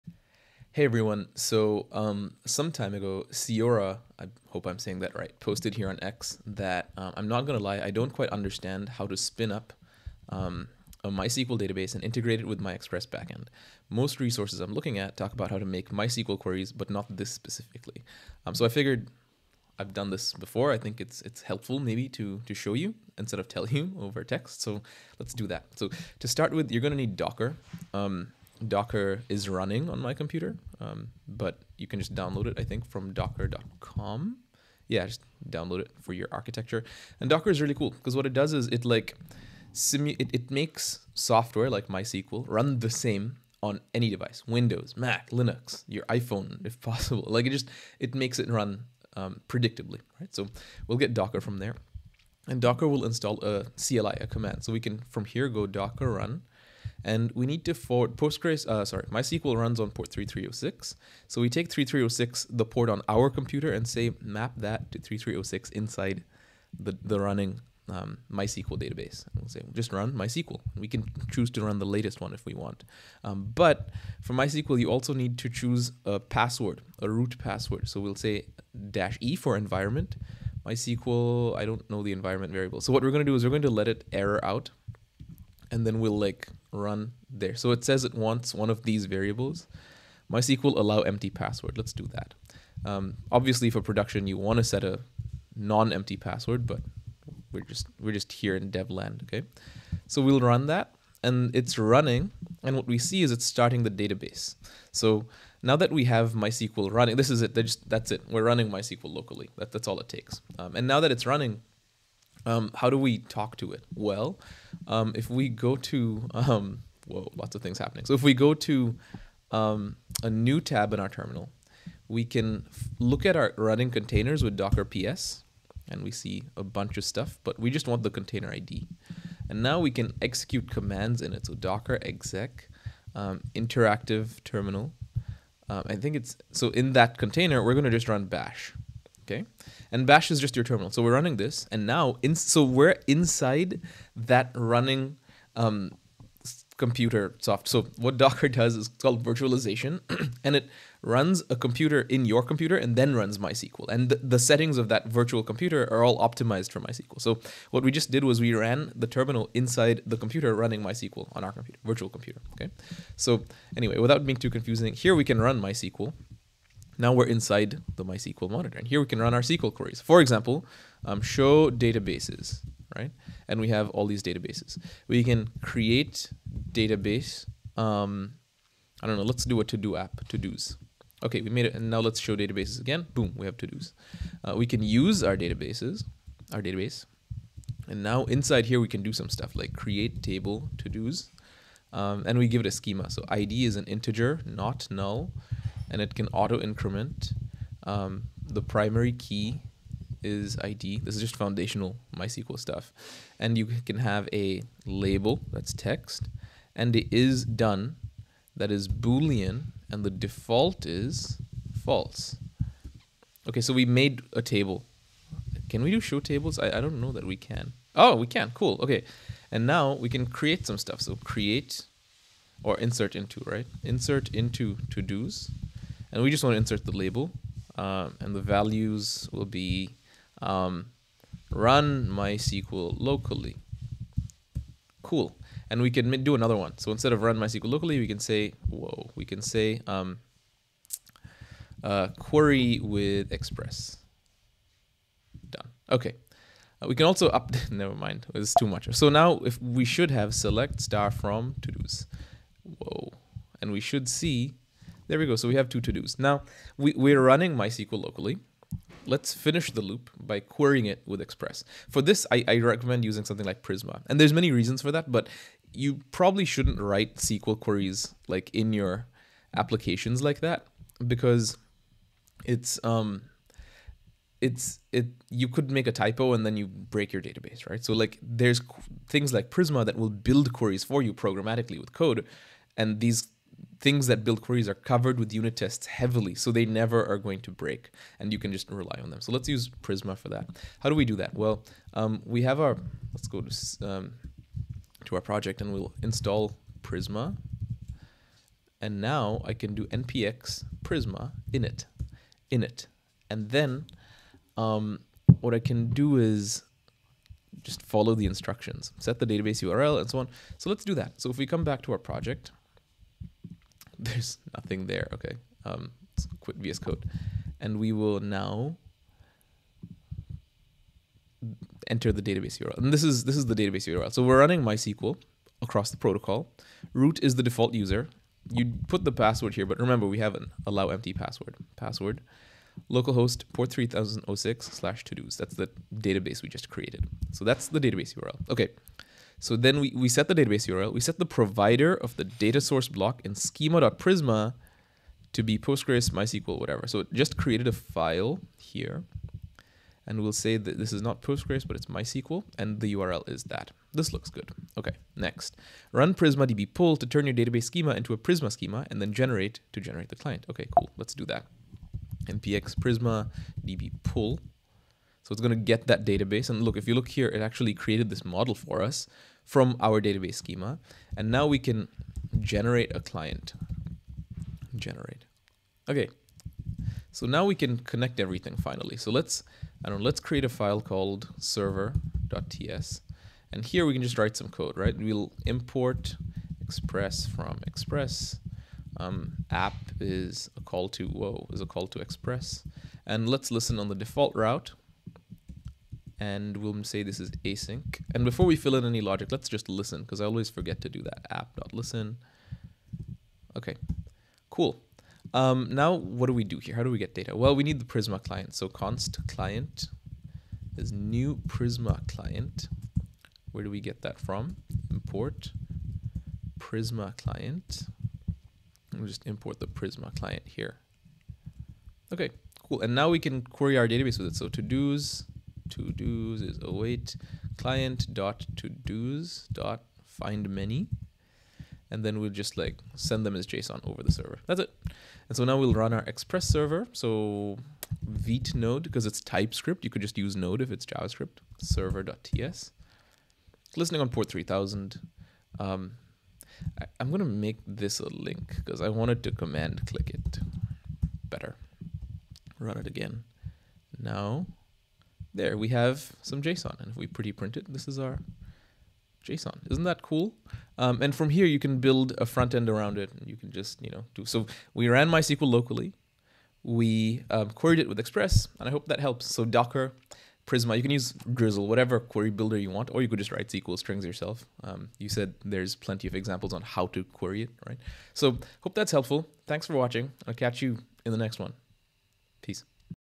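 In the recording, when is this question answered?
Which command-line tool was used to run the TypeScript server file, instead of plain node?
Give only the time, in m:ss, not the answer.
7:18.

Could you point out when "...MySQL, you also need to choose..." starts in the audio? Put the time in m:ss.
1:14.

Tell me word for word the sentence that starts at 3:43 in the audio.
Insert into to-dos and we just want to insert the label um, and the values will be um, run MySQL locally.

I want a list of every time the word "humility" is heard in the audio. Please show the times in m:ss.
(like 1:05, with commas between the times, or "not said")
not said.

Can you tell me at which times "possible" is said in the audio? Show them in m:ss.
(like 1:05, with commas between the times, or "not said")
0:46.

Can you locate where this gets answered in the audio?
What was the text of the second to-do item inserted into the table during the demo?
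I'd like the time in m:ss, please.
4:02.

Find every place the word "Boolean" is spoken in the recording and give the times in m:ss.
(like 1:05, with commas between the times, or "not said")
3:28.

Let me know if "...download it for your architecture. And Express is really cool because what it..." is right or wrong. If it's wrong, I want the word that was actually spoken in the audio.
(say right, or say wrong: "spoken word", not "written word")
wrong: "Docker", not "Express".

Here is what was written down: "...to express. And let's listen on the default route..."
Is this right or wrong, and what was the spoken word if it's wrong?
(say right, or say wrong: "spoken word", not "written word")
right.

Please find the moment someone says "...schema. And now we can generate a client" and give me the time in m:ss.
6:10.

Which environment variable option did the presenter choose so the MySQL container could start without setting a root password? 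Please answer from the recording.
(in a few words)
MySQL allow empty password.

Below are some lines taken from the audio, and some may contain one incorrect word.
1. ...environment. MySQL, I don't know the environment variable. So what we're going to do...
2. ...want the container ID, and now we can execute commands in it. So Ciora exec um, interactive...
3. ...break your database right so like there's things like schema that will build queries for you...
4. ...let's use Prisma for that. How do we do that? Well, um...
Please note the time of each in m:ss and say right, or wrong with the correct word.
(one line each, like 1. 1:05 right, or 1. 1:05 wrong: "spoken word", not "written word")
1. 1:19 right
2. 2:07 wrong: "Docker", not "Ciora"
3. 4:36 wrong: "prisma", not "schema"
4. 4:49 right.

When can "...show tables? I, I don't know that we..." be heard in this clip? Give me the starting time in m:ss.
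3:35.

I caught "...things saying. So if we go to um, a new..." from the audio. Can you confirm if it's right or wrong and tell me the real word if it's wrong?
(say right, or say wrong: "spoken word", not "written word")
wrong: "happening", not "saying".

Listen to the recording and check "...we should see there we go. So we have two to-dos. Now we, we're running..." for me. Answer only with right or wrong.
right.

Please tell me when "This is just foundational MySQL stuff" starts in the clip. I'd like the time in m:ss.
3:21.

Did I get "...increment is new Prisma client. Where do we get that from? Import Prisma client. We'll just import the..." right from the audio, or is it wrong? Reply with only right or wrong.
wrong.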